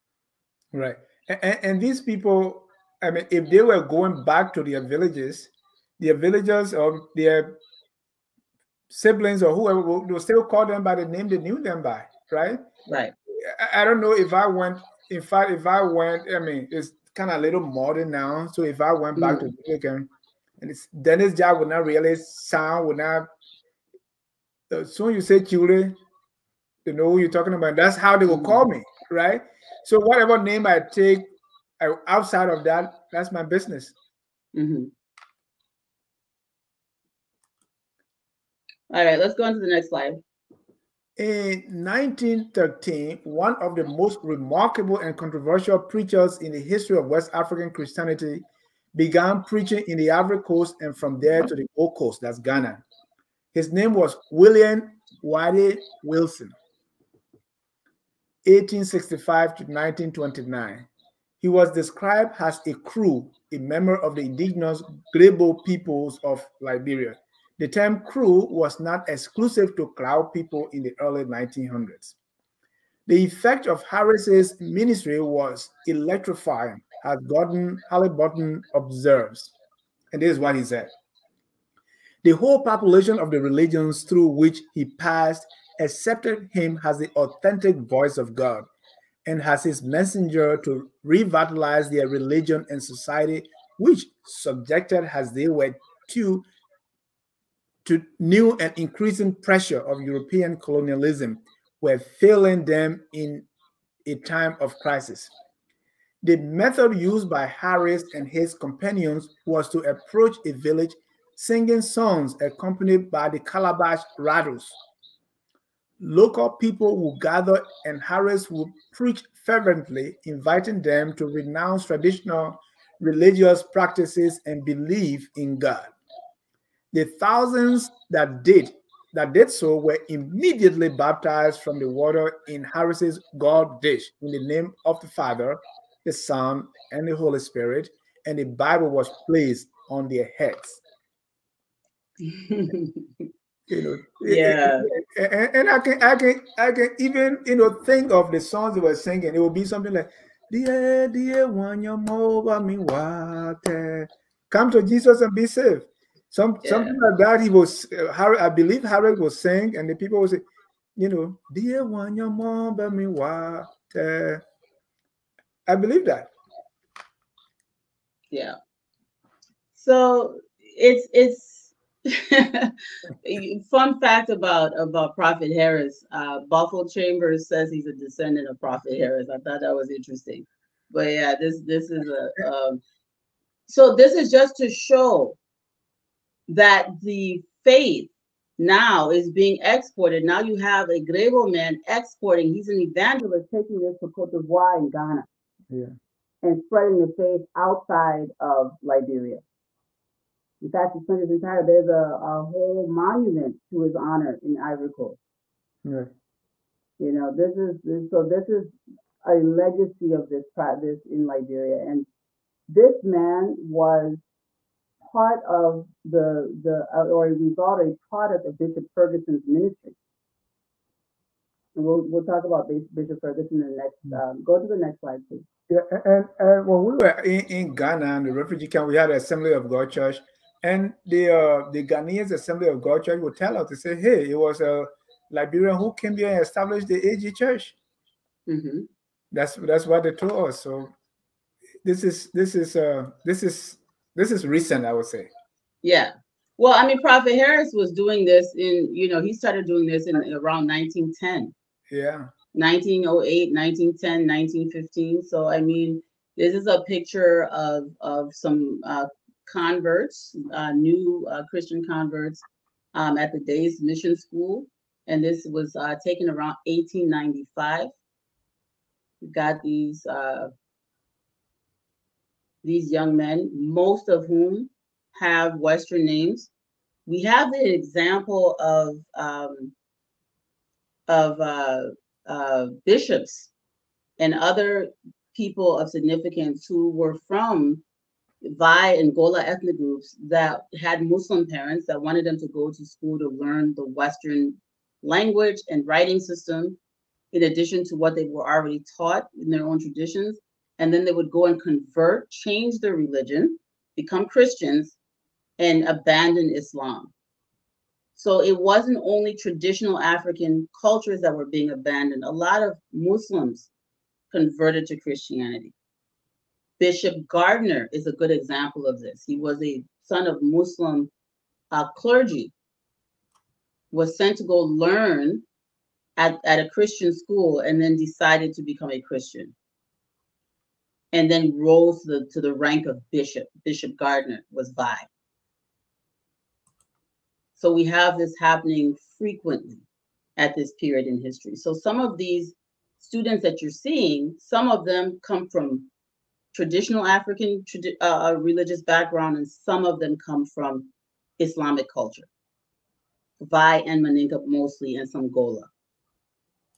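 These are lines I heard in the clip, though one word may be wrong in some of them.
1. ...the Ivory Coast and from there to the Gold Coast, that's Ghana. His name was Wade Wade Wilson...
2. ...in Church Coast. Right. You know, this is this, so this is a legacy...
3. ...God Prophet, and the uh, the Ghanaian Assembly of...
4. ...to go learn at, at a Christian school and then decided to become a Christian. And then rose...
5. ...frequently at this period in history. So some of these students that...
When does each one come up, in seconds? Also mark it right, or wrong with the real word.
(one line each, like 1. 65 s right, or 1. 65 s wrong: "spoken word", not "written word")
1. 49 s wrong: "William", not "Wade"
2. 204 s wrong: "Ivory", not "Church"
3. 229 s wrong: "Church", not "Prophet"
4. 324 s right
5. 339 s right.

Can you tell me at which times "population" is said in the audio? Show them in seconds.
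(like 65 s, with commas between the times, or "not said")
82 s.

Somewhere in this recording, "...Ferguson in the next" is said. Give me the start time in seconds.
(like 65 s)
223 s.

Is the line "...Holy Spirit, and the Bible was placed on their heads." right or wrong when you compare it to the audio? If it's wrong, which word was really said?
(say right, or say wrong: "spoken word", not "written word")
right.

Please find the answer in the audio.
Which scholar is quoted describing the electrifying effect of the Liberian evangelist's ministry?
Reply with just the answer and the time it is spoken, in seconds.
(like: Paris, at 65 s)
Gordon Haliburton, at 77 s.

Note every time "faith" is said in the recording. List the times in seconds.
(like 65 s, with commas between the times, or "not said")
187 s, 197 s.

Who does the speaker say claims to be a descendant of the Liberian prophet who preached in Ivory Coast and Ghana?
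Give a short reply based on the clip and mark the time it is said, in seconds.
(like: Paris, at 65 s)
Buffalo Chambers, at 176 s.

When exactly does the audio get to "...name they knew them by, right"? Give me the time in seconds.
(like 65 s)
11 s.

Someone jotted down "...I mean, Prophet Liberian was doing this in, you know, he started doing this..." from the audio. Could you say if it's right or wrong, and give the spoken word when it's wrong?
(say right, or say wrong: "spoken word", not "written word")
wrong: "Harris", not "Liberian".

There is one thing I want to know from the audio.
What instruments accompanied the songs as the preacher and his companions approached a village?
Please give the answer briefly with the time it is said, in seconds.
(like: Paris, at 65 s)
calabash rattles, at 113 s.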